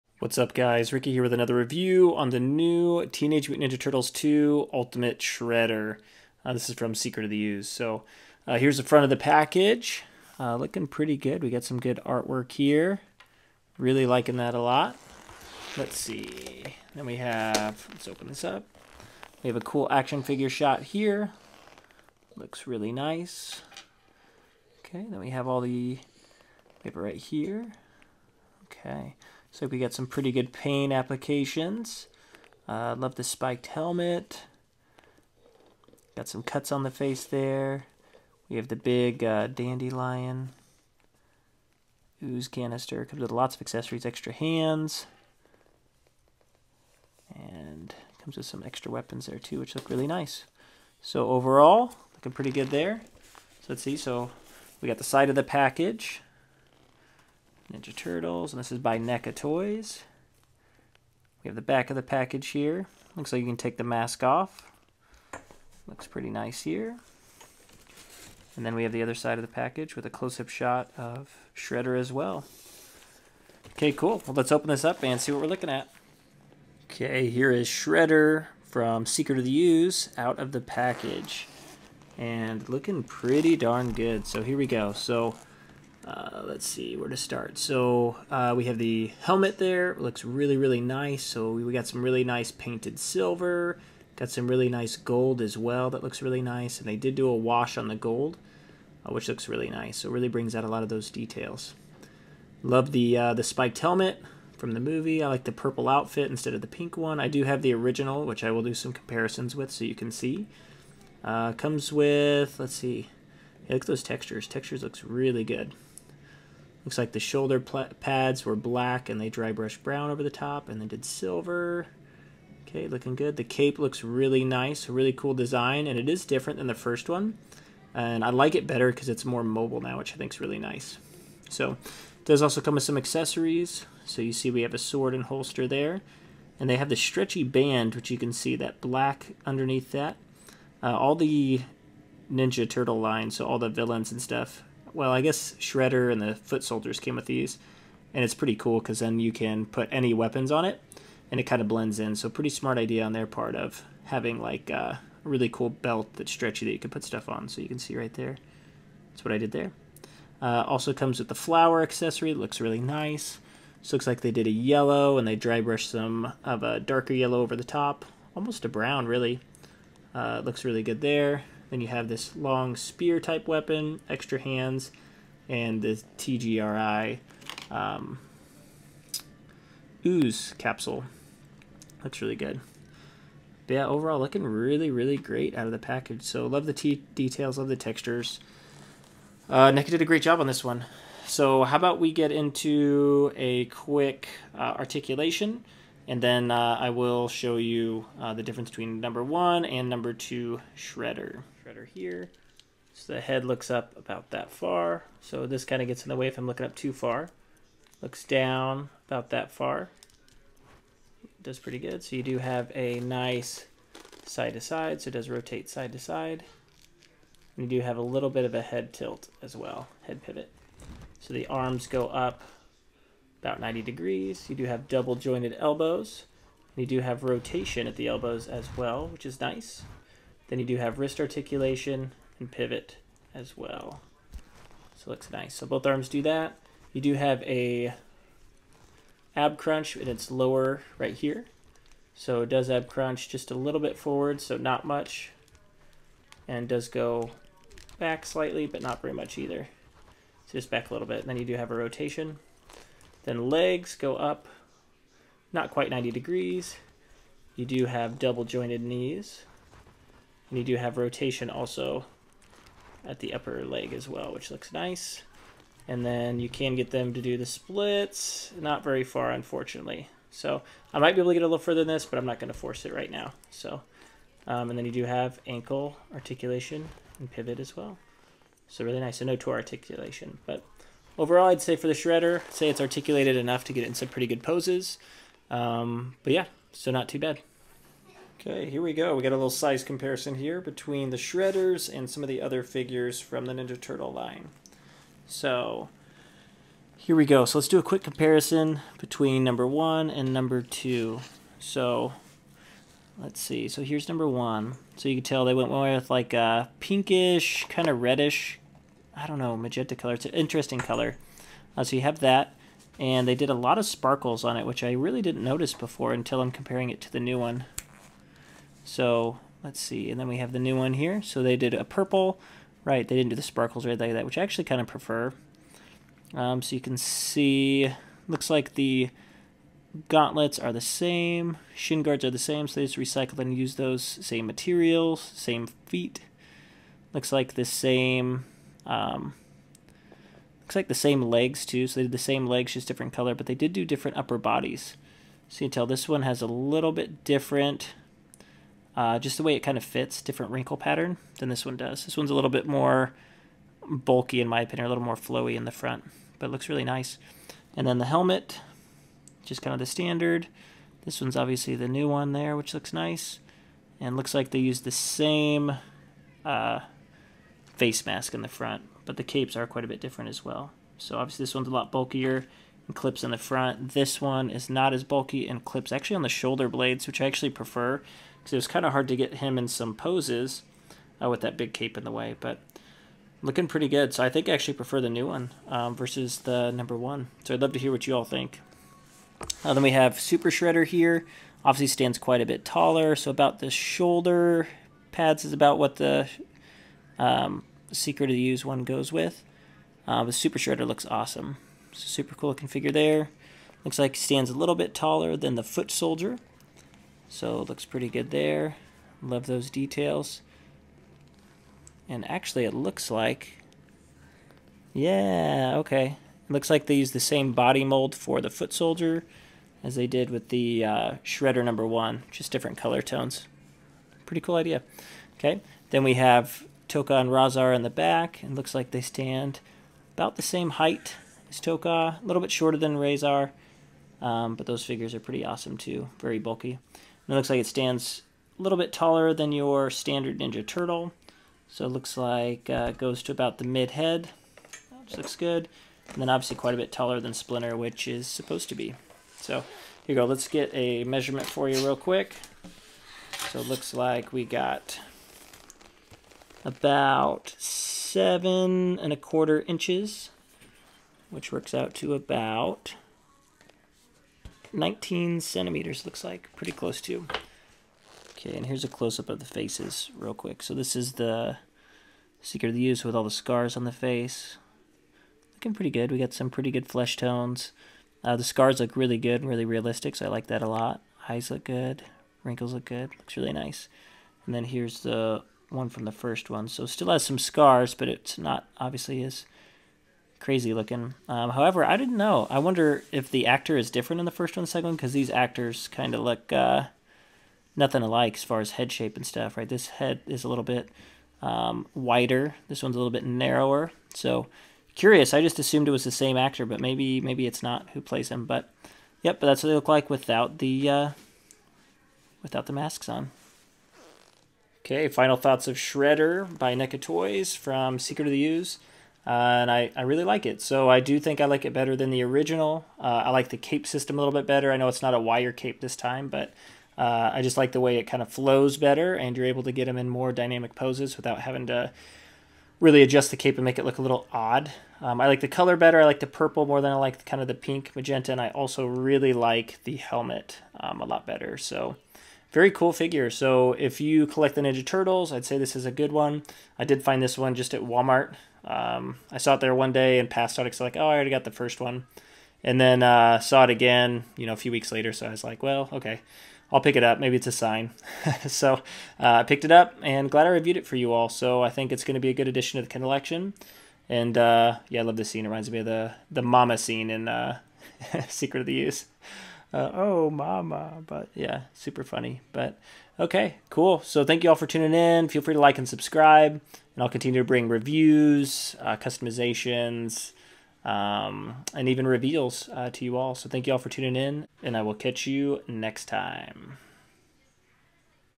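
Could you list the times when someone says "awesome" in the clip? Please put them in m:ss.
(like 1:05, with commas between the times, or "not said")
6:41, 7:15.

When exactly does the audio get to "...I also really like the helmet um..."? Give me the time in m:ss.
8:58.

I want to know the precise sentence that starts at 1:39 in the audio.
So really brings out a lot of those details.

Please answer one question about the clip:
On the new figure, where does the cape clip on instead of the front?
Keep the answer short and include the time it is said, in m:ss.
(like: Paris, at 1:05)
Shoulder blades, at 6:16.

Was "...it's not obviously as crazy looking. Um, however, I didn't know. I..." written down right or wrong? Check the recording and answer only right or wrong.
right.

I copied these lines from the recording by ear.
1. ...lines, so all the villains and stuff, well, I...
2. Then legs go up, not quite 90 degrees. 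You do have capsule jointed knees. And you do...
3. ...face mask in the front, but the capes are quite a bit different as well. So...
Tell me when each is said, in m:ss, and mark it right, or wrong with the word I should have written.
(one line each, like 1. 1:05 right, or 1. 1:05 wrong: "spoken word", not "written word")
1. 2:22 right
2. 4:13 wrong: "double", not "capsule"
3. 6:07 right.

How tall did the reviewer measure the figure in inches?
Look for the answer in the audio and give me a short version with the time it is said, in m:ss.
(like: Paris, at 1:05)
7.25 inches, at 7:37.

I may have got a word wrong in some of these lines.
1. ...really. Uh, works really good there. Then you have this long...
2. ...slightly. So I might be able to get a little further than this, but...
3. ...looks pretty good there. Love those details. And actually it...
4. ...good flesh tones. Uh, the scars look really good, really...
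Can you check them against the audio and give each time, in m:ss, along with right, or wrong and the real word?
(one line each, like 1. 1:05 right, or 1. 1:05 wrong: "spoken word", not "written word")
1. 2:49 wrong: "looks", not "works"
2. 4:29 wrong: "unfortunately", not "slightly"
3. 6:47 right
4. 7:56 right.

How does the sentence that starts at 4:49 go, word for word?
We got a little size comparison here between the Shredders and some of the other figures from the Ninja Turtle line.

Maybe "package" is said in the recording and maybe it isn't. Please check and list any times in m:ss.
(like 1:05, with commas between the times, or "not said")
0:09, 0:55, 1:02, 1:09, 1:20, 3:05.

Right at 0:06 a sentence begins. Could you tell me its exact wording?
Uh, this is from Secret of the Ooze.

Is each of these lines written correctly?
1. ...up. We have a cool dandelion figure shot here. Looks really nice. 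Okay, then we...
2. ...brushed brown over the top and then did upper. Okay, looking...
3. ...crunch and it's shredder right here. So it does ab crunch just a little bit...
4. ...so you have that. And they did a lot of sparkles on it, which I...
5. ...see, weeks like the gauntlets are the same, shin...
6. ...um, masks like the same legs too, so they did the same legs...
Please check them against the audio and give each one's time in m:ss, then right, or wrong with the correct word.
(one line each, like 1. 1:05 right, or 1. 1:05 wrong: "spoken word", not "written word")
1. 0:18 wrong: "action", not "dandelion"
2. 1:59 wrong: "silver", not "upper"
3. 3:59 wrong: "lower", not "shredder"
4. 5:11 right
5. 5:26 wrong: "looks", not "weeks"
6. 5:38 wrong: "looks", not "masks".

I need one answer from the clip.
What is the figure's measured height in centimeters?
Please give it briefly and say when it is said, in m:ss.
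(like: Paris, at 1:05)
19, at 7:44.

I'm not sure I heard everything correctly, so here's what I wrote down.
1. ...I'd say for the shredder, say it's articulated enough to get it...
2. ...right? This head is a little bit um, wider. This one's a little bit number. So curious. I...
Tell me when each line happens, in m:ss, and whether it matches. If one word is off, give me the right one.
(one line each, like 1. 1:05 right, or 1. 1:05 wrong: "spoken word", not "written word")
1. 4:41 right
2. 8:19 wrong: "narrower", not "number".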